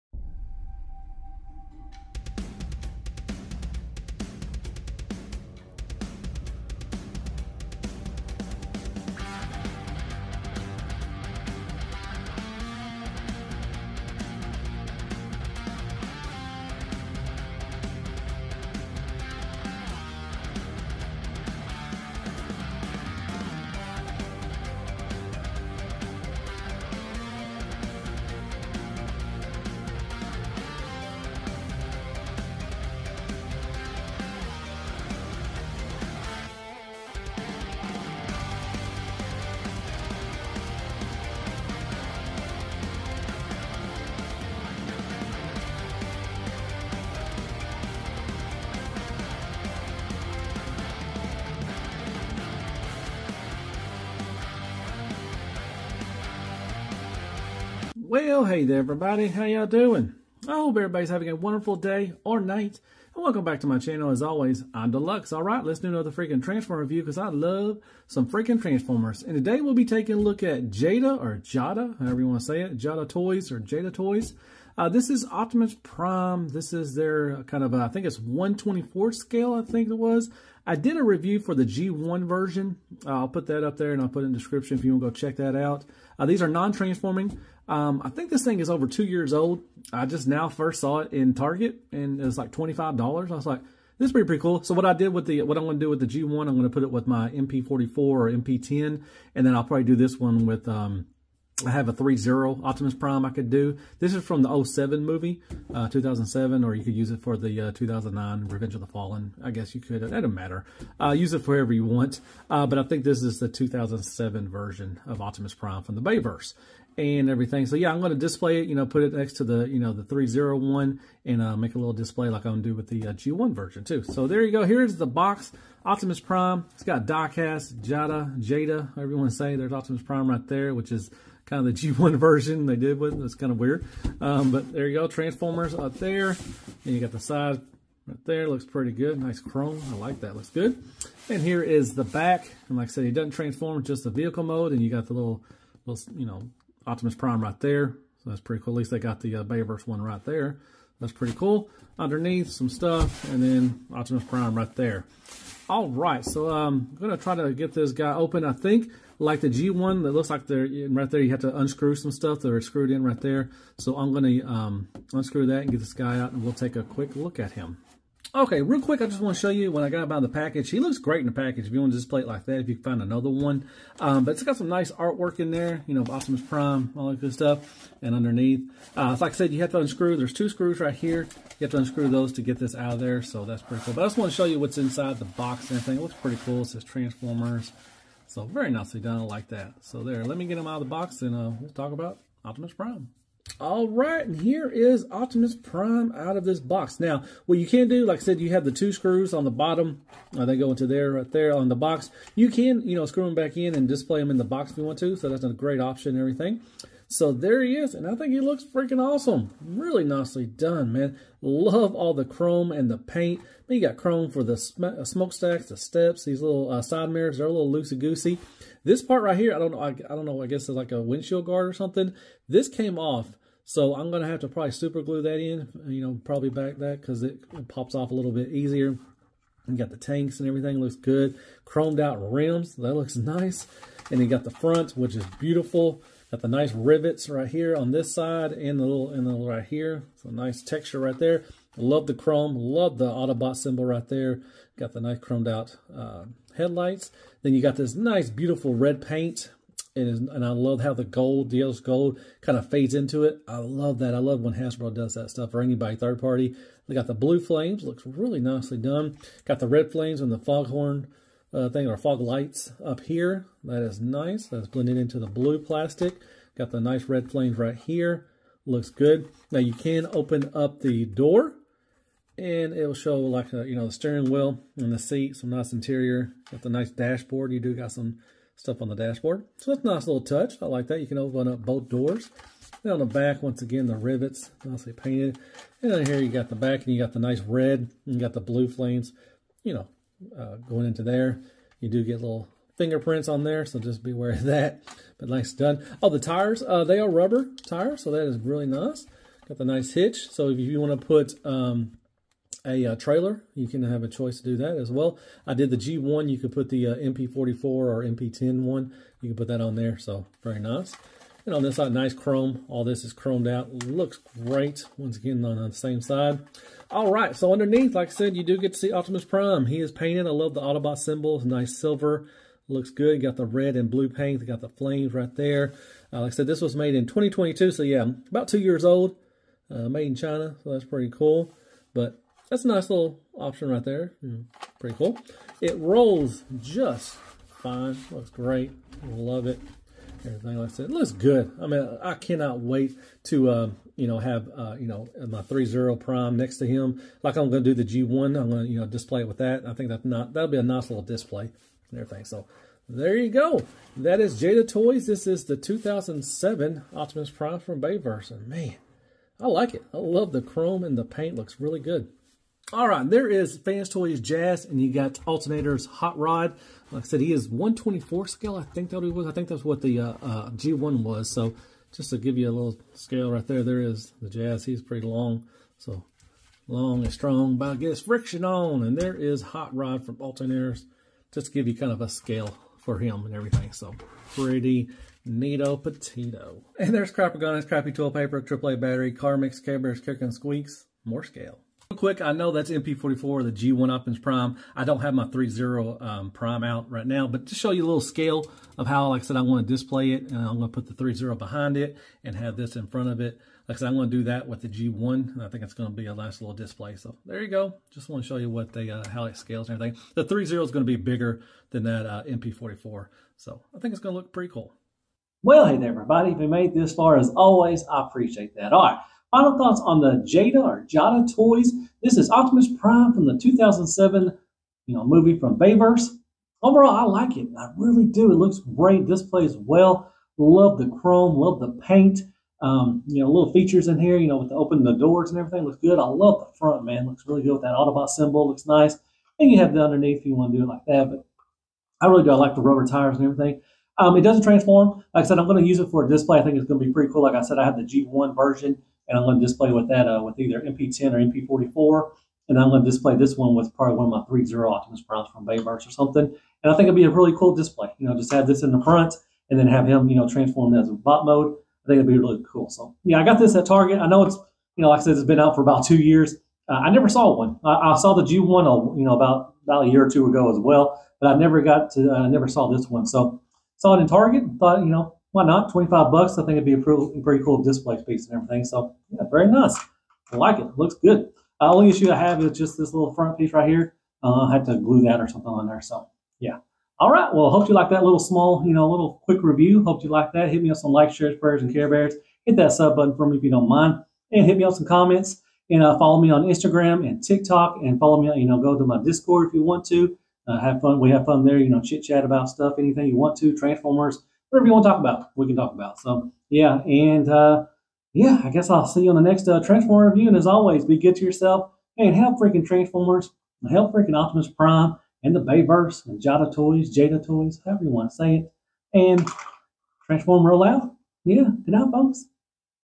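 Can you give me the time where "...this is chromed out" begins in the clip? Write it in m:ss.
5:12.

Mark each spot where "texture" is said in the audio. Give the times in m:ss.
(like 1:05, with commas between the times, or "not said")
4:00.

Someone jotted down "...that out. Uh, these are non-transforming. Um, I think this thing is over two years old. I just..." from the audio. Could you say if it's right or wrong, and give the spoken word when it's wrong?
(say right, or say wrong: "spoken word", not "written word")
right.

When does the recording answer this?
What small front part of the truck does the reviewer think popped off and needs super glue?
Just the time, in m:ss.
3:41.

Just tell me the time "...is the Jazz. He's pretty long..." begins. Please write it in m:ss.
6:13.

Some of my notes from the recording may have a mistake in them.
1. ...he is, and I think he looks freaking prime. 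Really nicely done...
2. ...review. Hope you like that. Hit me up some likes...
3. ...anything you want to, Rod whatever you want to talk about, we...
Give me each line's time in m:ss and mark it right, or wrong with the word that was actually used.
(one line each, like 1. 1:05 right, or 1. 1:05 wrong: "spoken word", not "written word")
1. 3:27 wrong: "awesome", not "prime"
2. 8:09 right
3. 8:22 wrong: "Transformers", not "Rod".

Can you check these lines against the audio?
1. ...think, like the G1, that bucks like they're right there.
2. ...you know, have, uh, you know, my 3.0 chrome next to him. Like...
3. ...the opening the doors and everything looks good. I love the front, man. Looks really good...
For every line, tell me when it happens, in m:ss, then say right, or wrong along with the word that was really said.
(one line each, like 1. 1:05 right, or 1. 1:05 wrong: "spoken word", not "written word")
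1. 2:38 wrong: "looks", not "bucks"
2. 5:43 wrong: "prime", not "chrome"
3. 7:14 right.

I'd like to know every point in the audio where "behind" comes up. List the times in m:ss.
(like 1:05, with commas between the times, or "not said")
6:41.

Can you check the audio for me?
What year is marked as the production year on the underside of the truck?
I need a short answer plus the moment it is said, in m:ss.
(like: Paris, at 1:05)
2022, at 5:27.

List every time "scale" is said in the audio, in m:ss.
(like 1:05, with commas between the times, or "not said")
1:19, 6:08, 6:12, 6:22, 6:31, 6:38, 6:49.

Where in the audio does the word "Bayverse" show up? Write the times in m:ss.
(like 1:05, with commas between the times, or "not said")
1:56, 2:29, 5:57, 7:05, 7:35, 8:35.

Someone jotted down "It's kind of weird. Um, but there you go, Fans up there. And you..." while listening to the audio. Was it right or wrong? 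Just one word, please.
wrong.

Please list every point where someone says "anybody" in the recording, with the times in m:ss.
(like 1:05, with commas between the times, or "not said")
4:15.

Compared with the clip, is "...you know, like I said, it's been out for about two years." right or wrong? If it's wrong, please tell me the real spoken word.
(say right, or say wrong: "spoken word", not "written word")
right.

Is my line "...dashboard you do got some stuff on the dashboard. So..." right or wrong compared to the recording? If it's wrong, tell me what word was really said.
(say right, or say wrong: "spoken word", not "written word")
right.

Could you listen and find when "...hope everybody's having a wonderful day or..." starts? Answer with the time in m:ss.
1:00.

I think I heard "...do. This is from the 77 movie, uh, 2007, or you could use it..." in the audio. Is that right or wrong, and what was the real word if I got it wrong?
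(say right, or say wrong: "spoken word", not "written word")
wrong: "07", not "77".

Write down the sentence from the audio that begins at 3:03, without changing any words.
But I just want to show you what's inside the box and everything.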